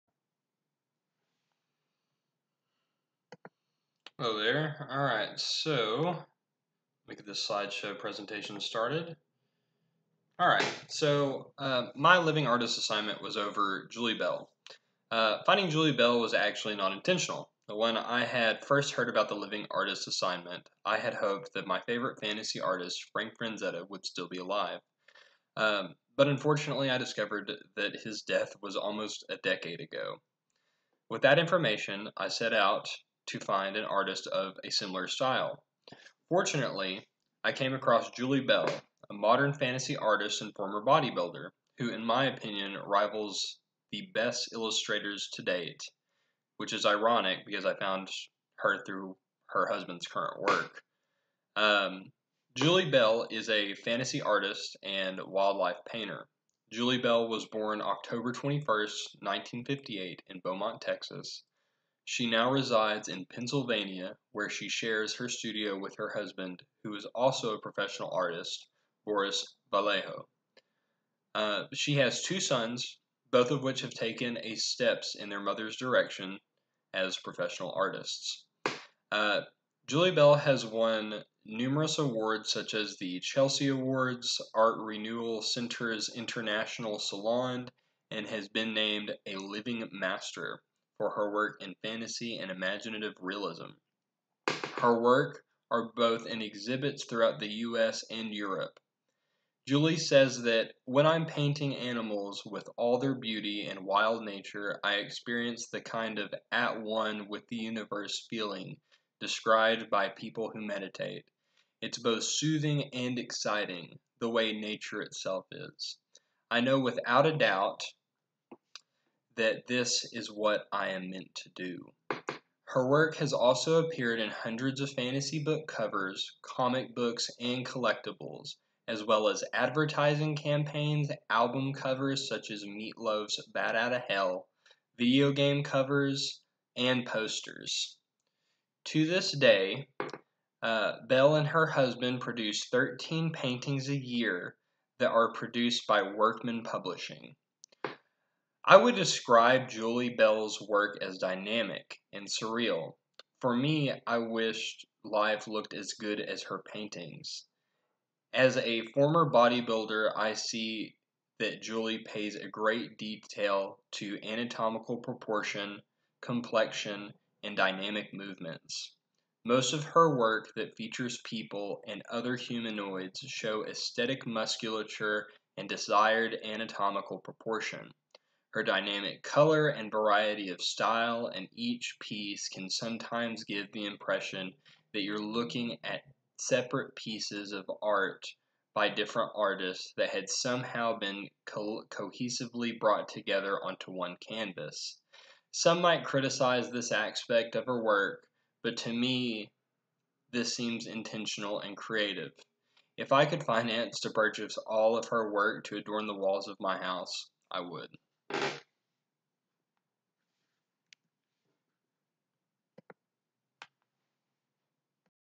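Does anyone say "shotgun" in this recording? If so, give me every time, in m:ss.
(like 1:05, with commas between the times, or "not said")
not said.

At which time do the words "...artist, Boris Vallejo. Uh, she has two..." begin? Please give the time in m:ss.
1:08.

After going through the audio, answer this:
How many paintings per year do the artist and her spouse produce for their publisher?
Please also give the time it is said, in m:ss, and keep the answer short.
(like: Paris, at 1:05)
13, at 2:22.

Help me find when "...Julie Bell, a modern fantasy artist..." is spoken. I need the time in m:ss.
0:38.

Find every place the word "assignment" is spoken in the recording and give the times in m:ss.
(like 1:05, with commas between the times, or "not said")
0:12, 0:20.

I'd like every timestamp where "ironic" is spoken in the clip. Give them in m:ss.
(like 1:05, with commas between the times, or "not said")
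0:46.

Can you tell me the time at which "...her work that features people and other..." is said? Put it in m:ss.
2:49.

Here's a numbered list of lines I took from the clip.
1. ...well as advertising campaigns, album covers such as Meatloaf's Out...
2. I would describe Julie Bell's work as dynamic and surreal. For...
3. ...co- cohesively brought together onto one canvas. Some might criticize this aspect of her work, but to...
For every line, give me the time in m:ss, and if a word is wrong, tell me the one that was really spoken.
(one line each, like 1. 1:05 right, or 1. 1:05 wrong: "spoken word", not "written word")
1. 2:09 right
2. 2:28 right
3. 3:11 right.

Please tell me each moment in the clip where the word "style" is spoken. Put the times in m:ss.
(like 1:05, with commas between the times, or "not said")
0:35, 3:00.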